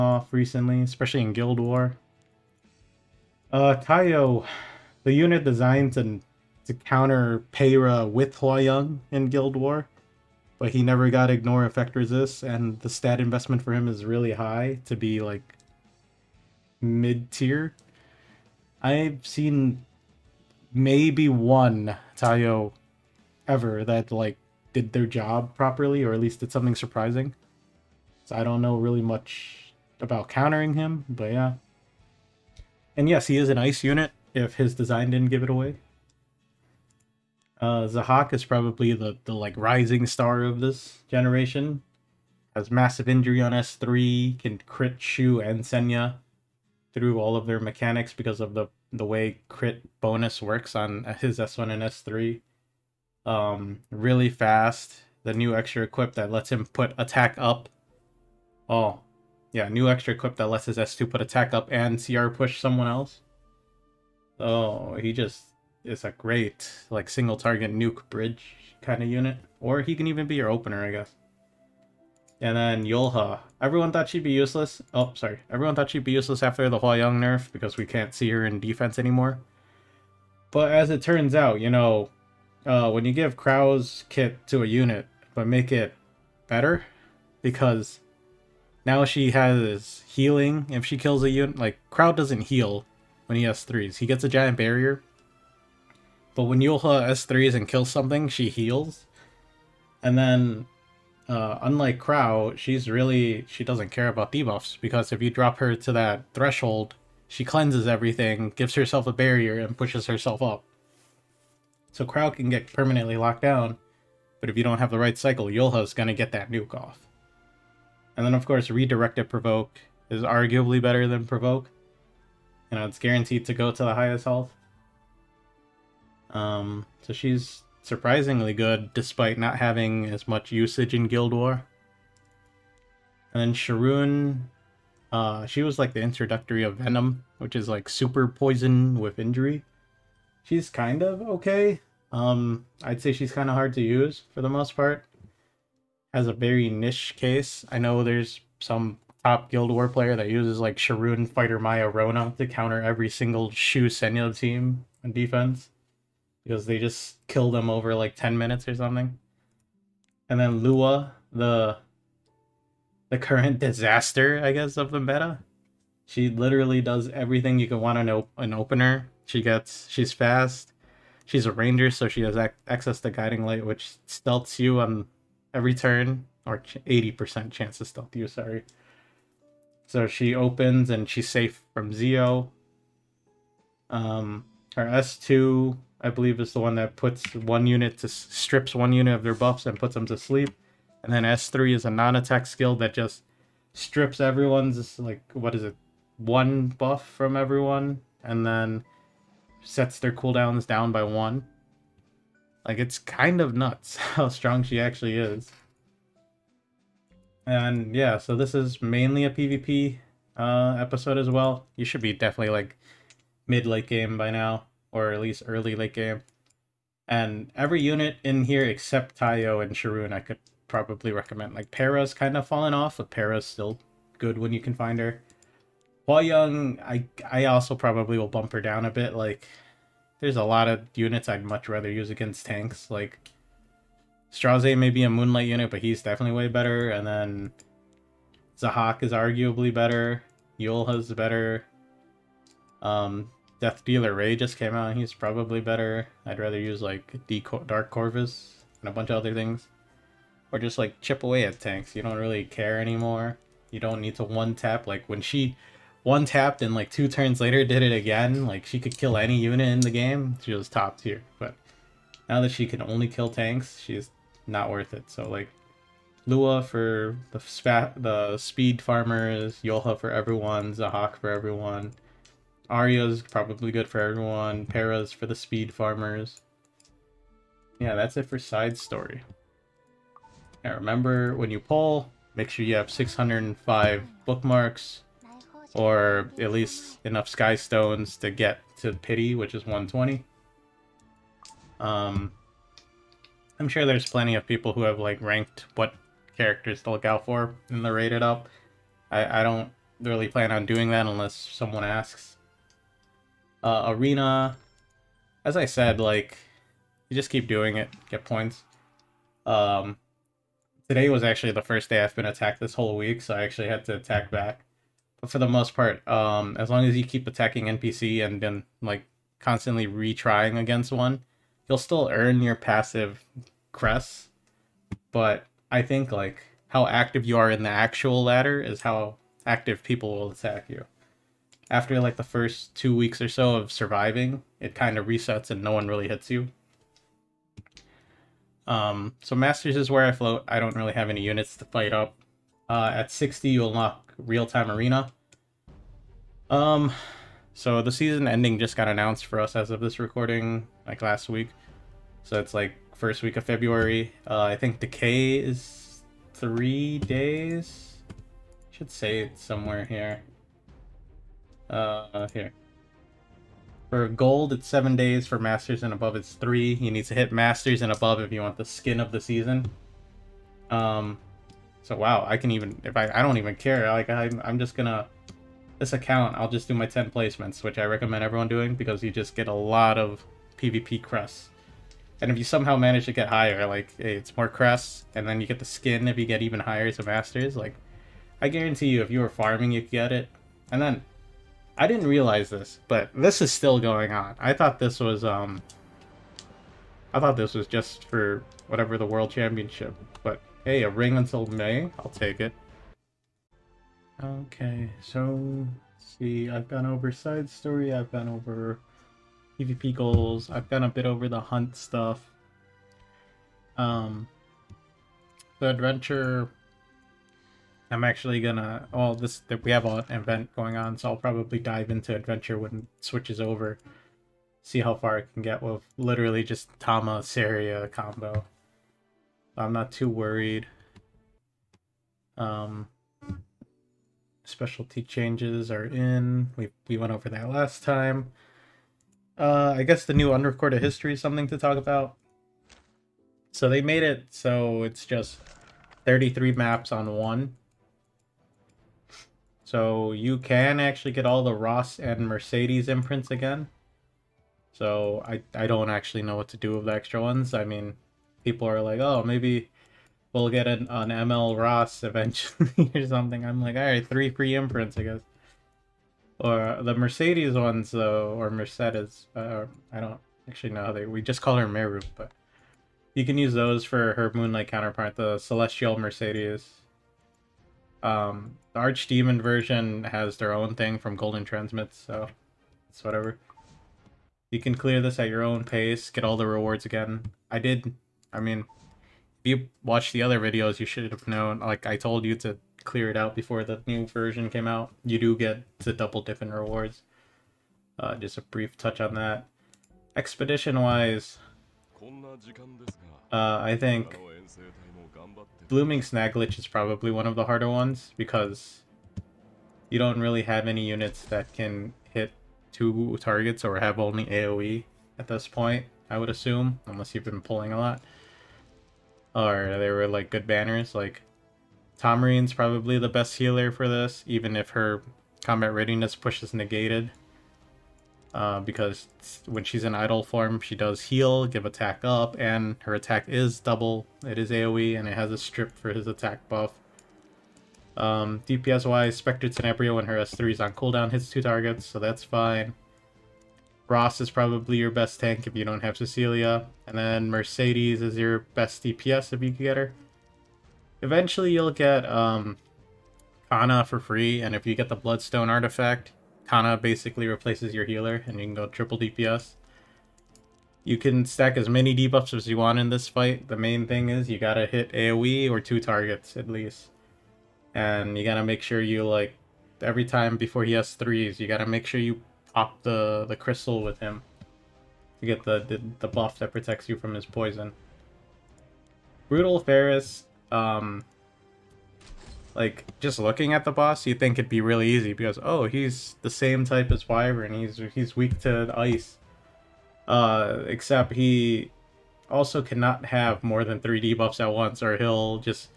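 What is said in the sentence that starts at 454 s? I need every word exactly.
So I, I don't actually know what to do with the extra ones.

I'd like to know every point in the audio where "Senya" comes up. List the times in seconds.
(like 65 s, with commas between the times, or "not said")
45 s, 153 s.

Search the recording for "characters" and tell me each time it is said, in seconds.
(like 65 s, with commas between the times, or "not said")
296 s.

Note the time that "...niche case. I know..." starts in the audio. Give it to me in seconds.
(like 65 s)
146 s.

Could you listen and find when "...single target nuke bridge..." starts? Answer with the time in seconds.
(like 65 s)
67 s.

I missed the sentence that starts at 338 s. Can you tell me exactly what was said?
Um, so Masters is where I float.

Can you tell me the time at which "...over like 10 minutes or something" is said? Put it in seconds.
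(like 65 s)
157 s.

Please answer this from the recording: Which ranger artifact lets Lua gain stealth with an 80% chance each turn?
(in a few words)
Guiding Light.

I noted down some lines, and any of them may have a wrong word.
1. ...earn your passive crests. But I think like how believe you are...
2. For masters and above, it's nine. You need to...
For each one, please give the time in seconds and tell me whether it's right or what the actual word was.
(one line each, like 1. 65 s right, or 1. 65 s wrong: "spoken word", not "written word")
1. 322 s wrong: "active", not "believe"
2. 365 s wrong: "three", not "nine".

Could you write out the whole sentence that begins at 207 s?
And yeah, so this is mainly a PvP uh, episode as well.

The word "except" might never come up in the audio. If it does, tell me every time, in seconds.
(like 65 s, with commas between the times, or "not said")
218 s, 590 s.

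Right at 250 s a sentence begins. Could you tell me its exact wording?
Or just, like, chip away at tanks.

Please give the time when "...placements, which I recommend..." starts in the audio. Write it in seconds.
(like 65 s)
377 s.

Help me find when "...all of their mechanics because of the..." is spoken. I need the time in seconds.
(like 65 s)
47 s.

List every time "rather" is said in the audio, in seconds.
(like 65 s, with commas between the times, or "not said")
231 s, 246 s.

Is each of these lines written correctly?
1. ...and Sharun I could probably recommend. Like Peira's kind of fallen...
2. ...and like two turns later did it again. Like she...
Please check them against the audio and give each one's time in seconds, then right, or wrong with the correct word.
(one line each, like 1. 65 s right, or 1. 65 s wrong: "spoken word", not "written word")
1. 219 s right
2. 256 s right.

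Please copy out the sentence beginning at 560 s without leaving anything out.
You can stack as many debuffs as you want in this fight.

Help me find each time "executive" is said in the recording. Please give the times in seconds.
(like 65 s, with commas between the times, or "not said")
not said.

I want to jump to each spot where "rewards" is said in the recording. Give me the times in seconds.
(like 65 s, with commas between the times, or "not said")
486 s, 496 s.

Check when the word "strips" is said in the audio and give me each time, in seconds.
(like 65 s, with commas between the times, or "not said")
188 s, 193 s, 535 s.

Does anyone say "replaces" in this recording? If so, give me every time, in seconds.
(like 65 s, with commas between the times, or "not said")
557 s.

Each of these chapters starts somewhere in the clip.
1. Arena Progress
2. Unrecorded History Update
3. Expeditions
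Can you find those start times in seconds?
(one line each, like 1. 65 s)
1. 305 s
2. 441 s
3. 500 s.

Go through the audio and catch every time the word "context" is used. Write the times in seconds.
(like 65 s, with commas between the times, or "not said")
not said.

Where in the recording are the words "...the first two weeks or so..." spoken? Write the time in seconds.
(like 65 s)
332 s.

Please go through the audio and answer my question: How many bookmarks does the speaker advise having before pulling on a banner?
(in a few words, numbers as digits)
605.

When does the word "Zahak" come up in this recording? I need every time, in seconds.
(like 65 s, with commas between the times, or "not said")
37 s, 238 s, 270 s.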